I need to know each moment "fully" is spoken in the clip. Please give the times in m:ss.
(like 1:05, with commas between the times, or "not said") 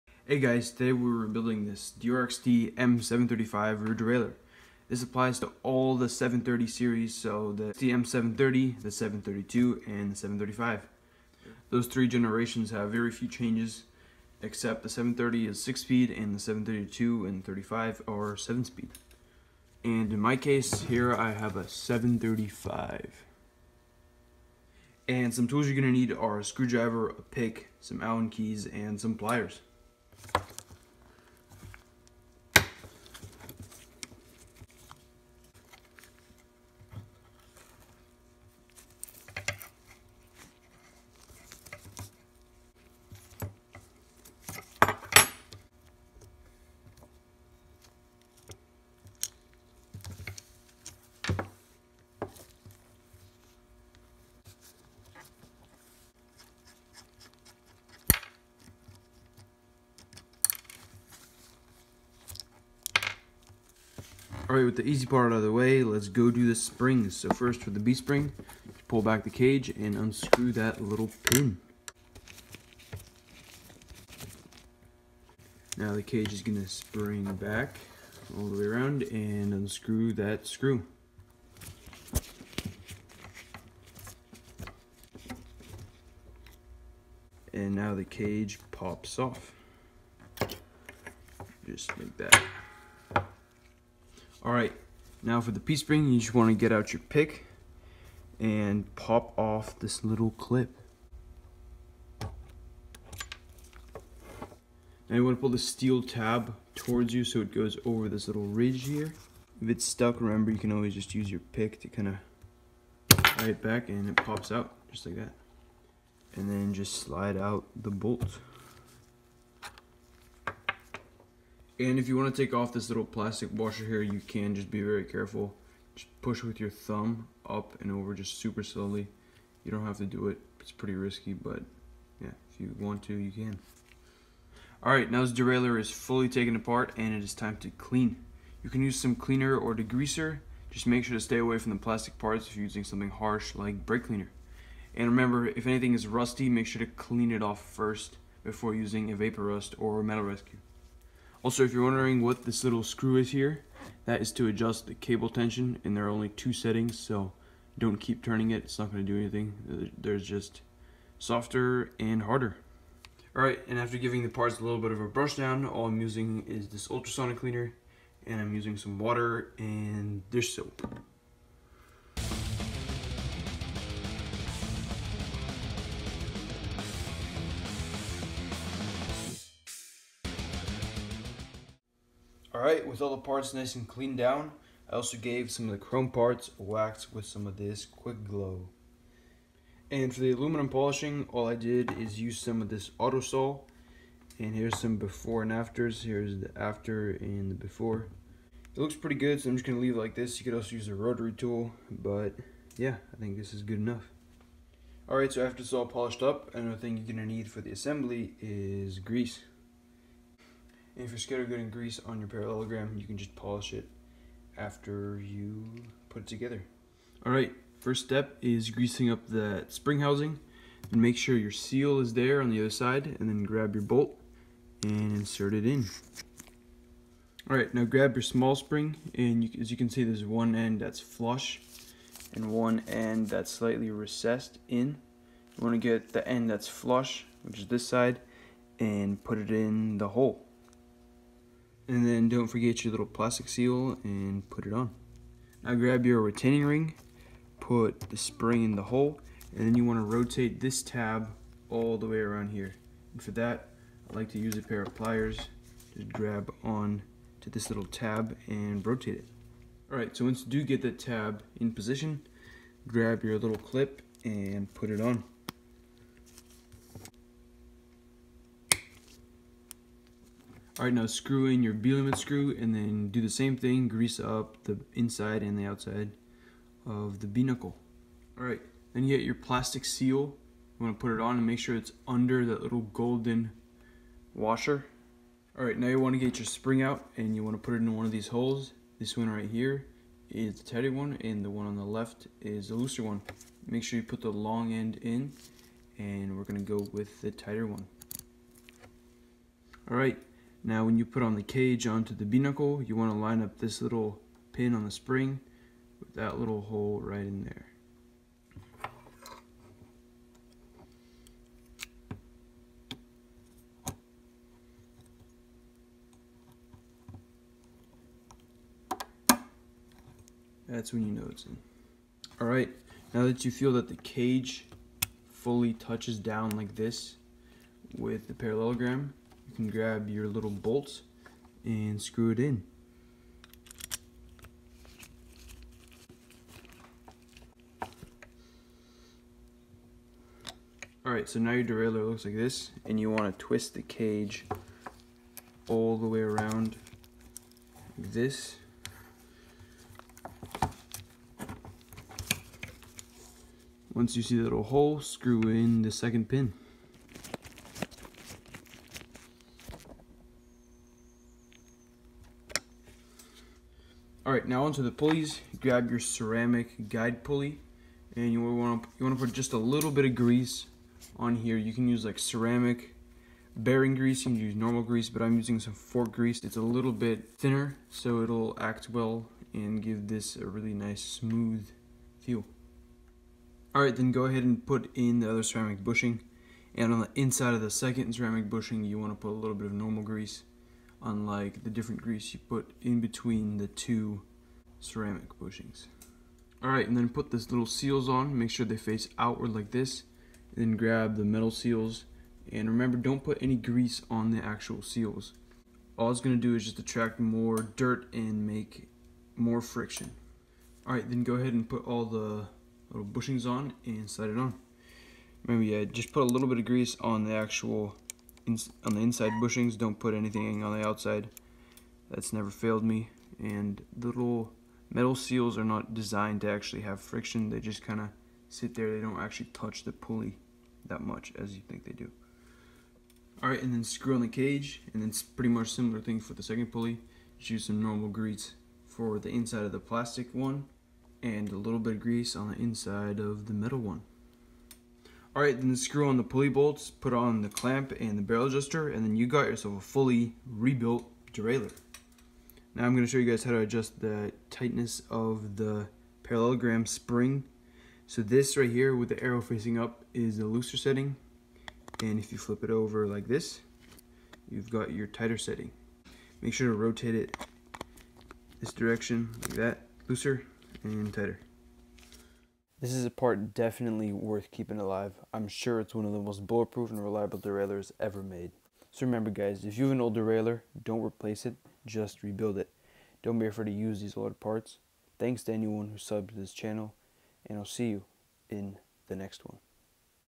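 2:15, 5:25, 7:29.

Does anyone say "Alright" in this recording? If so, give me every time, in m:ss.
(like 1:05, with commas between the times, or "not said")
1:04, 2:43, 3:02, 3:25, 4:19, 5:22, 5:41, 7:13.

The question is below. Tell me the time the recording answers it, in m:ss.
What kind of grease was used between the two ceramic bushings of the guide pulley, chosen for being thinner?
6:15.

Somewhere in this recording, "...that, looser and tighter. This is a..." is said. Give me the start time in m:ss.
7:49.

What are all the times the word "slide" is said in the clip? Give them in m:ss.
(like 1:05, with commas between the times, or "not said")
1:57, 6:54.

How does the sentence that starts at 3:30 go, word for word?
And if you're scared of getting grease on your parallelogram, you can just polish it after you put it together.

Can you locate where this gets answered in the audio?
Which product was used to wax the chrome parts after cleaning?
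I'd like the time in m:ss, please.
3:07.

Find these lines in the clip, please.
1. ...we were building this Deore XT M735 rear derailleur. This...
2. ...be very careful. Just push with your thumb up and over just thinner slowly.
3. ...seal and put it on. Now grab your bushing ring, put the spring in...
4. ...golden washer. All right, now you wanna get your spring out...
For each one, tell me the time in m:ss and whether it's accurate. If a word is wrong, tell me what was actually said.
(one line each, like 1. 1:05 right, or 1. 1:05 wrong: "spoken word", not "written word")
1. 0:00 right
2. 2:04 wrong: "super", not "thinner"
3. 4:03 wrong: "retaining", not "bushing"
4. 4:42 right.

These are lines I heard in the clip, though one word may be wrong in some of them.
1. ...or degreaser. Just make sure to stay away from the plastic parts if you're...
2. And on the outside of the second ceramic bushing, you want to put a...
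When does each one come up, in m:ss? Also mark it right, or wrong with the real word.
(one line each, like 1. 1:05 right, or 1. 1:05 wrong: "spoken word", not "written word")
1. 2:19 right
2. 6:26 wrong: "inside", not "outside".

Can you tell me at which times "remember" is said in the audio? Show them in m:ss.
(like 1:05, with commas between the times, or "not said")
1:50, 2:25, 6:42, 6:55, 7:59.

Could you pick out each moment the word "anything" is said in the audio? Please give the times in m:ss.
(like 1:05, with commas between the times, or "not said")
2:25, 2:39, 7:00.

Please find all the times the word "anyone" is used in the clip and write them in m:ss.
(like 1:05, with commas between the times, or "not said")
8:05.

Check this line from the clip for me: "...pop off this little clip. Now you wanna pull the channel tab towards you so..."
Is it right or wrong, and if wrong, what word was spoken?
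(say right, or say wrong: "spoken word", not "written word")
wrong: "steel", not "channel".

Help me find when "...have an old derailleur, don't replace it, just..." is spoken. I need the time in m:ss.
7:59.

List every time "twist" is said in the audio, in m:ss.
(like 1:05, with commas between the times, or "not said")
5:43.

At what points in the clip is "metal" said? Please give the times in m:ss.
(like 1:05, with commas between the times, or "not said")
2:30, 6:41, 7:04, 7:23.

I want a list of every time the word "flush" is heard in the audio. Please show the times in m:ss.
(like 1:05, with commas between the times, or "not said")
3:50, 3:56.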